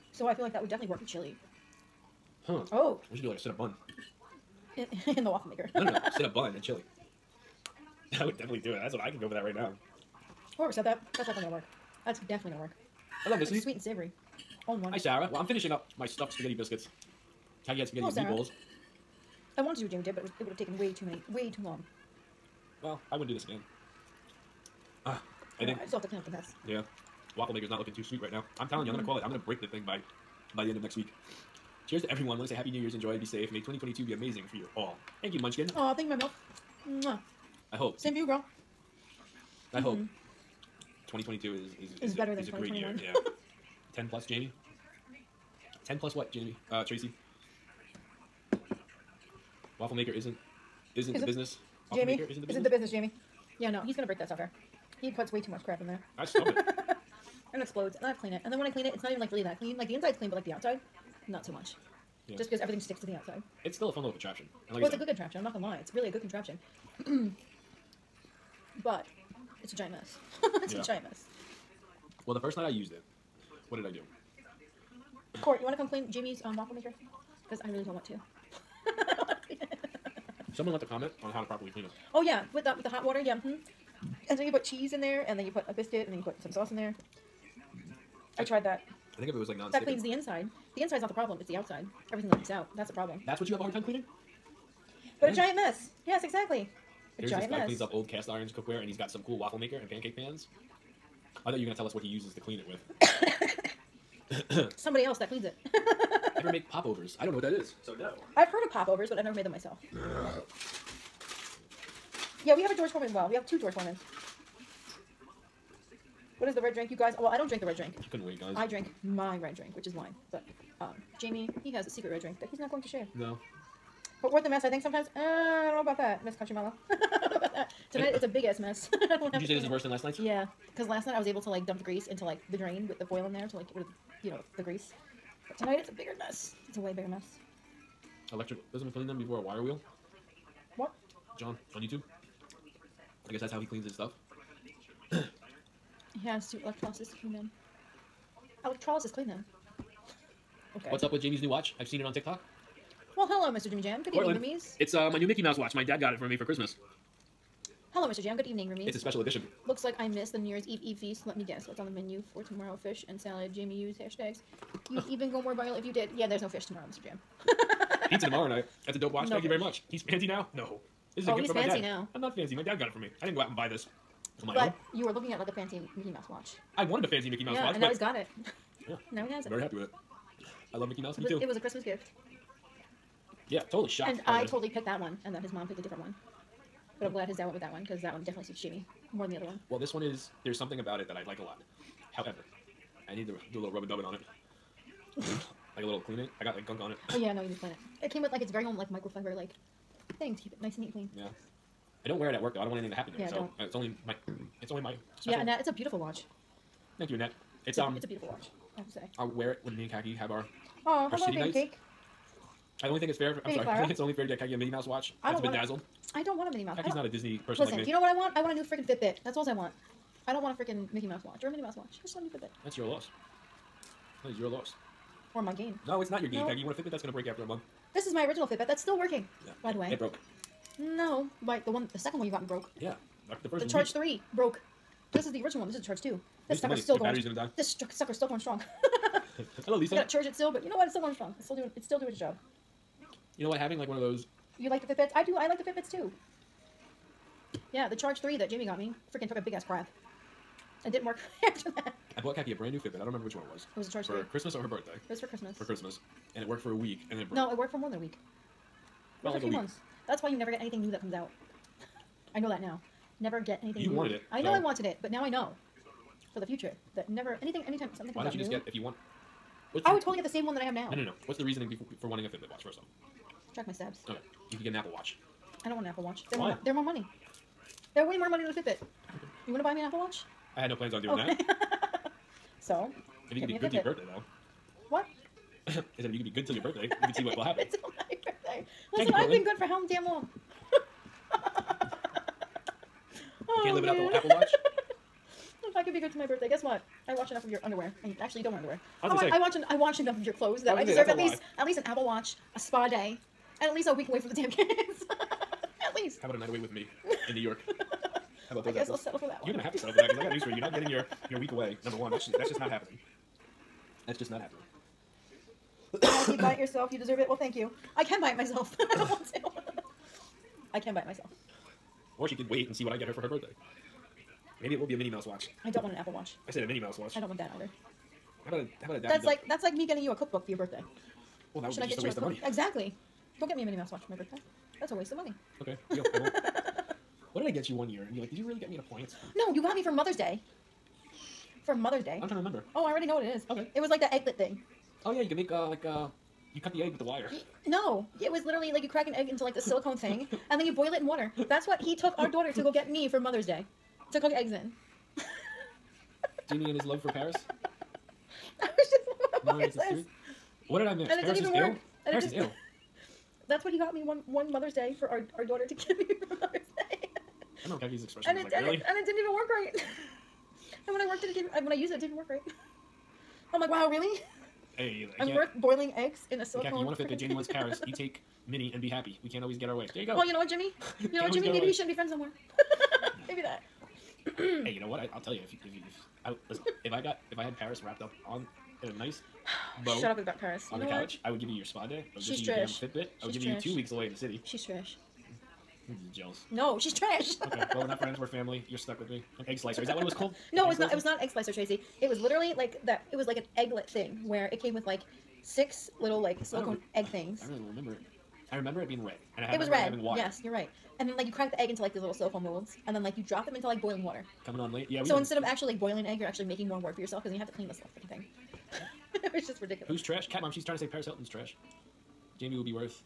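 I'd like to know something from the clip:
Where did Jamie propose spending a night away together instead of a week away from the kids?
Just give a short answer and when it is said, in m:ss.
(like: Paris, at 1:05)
New York, at 5:07.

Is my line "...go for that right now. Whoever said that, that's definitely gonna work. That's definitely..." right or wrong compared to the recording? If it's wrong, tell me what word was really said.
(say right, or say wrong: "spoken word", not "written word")
right.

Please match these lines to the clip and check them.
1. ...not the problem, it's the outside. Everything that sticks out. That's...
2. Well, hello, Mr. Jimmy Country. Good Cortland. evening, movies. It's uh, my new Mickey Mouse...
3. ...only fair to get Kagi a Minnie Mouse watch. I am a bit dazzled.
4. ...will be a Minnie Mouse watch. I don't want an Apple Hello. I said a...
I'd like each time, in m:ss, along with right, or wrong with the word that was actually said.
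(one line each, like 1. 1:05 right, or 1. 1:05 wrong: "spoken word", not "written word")
1. 1:31 wrong: "leaks", not "sticks"
2. 2:33 wrong: "Jam", not "Country"
3. 3:33 right
4. 5:24 wrong: "Watch", not "Hello".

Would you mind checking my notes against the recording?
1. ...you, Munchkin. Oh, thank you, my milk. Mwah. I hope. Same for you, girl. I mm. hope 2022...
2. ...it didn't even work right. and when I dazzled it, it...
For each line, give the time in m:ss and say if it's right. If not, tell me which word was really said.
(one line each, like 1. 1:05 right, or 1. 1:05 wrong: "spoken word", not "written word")
1. 0:35 right
2. 6:08 wrong: "worked", not "dazzled".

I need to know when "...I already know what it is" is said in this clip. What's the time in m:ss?
5:42.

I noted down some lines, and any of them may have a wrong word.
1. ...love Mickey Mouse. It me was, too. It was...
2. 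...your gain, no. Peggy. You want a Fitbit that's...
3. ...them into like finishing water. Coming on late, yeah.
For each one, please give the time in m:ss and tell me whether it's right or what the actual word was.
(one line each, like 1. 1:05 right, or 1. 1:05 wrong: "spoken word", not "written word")
1. 3:00 right
2. 3:46 right
3. 6:53 wrong: "boiling", not "finishing".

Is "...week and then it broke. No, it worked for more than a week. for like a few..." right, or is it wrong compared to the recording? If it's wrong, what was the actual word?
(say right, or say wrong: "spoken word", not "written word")
right.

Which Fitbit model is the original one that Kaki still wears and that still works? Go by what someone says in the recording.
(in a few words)
Charge 2.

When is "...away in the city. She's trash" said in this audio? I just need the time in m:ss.
6:33.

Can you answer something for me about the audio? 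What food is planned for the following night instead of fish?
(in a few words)
Pizza.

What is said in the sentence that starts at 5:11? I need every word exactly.
Number one, that's just, that's just not happening.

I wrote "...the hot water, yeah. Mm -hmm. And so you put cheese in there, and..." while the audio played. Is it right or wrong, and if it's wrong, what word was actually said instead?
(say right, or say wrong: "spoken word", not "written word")
right.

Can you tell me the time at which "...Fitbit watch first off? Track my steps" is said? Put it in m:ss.
4:32.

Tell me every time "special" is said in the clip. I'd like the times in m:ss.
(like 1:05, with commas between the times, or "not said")
2:38, 3:25.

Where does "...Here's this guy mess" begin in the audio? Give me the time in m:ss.
1:37.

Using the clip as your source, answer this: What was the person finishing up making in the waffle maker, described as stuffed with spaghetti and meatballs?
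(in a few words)
stuffed spaghetti biscuits.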